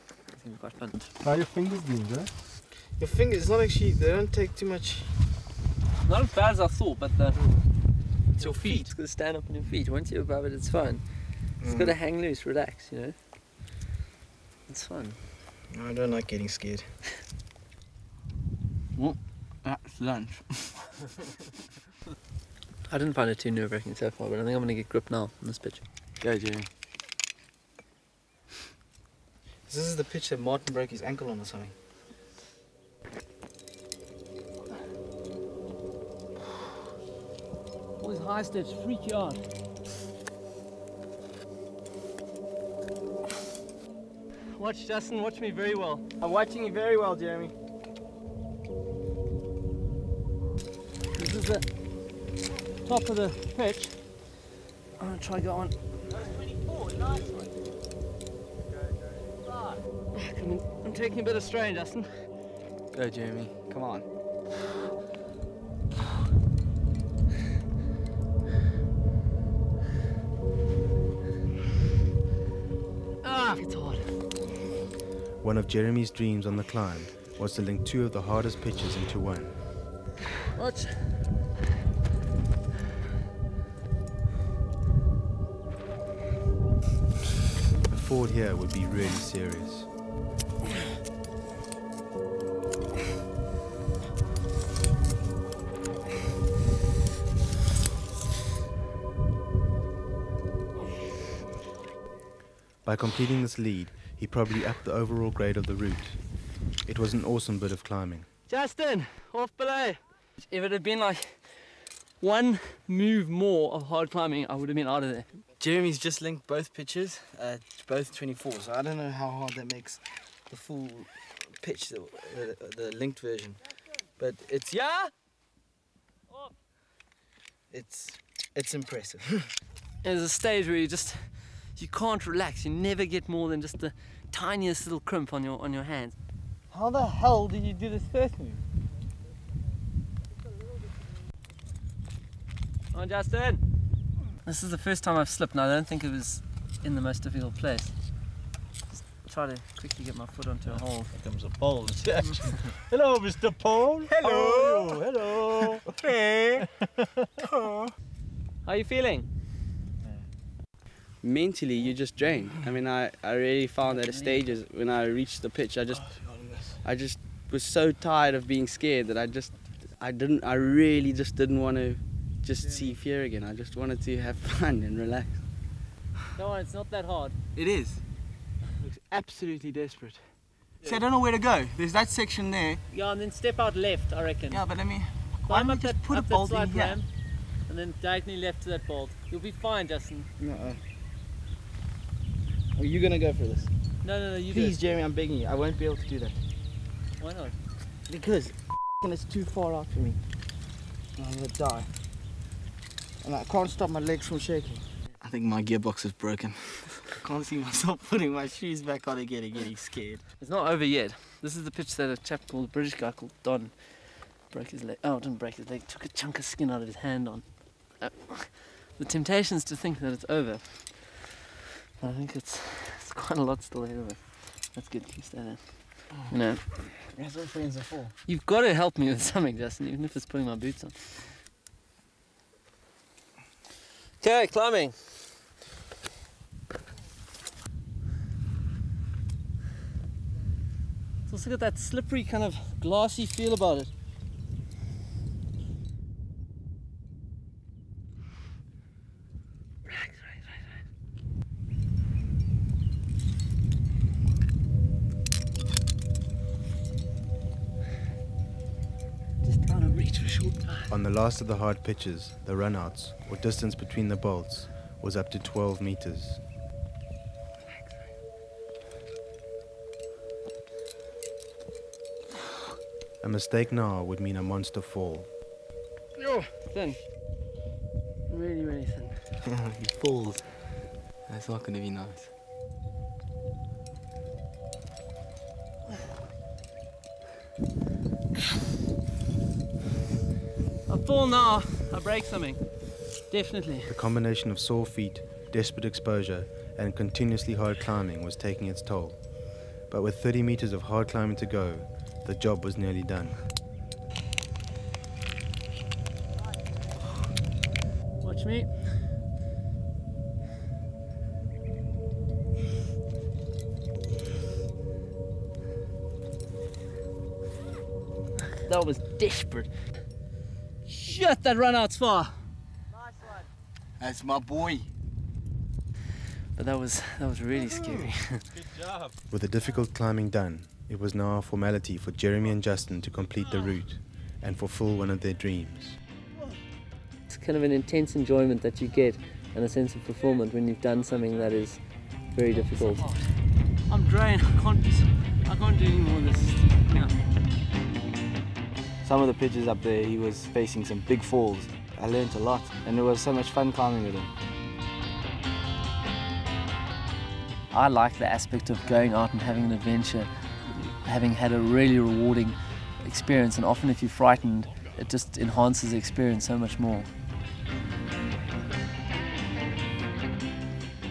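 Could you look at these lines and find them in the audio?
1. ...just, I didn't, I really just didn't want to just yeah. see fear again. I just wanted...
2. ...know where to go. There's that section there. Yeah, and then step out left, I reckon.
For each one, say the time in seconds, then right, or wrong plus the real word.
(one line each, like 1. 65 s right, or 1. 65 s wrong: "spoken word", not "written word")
1. 169 s right
2. 181 s right.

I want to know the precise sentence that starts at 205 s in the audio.
I think my gearbox is broken.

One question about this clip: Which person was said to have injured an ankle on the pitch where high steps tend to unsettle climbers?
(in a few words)
Martin.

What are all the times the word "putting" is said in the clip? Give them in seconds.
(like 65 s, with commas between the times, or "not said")
208 s, 230 s.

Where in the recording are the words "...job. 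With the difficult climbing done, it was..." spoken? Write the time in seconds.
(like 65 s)
328 s.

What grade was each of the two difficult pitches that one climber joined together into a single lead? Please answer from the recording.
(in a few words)
24.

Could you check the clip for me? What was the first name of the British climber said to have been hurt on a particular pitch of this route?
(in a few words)
Don.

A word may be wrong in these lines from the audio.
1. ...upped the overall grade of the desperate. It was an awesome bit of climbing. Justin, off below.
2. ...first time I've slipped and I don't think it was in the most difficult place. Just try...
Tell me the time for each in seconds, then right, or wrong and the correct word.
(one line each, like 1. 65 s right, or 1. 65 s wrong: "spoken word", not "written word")
1. 104 s wrong: "route", not "desperate"
2. 144 s right.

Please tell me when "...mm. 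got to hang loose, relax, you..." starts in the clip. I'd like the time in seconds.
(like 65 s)
11 s.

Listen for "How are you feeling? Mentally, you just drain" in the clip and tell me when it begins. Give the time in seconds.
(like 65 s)
157 s.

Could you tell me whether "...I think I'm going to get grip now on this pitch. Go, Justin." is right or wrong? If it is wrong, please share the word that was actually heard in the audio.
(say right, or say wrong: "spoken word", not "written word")
wrong: "Jimmy", not "Justin".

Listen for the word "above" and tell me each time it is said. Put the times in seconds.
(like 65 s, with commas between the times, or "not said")
10 s.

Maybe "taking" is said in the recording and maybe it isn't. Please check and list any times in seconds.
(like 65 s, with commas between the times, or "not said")
60 s, 298 s.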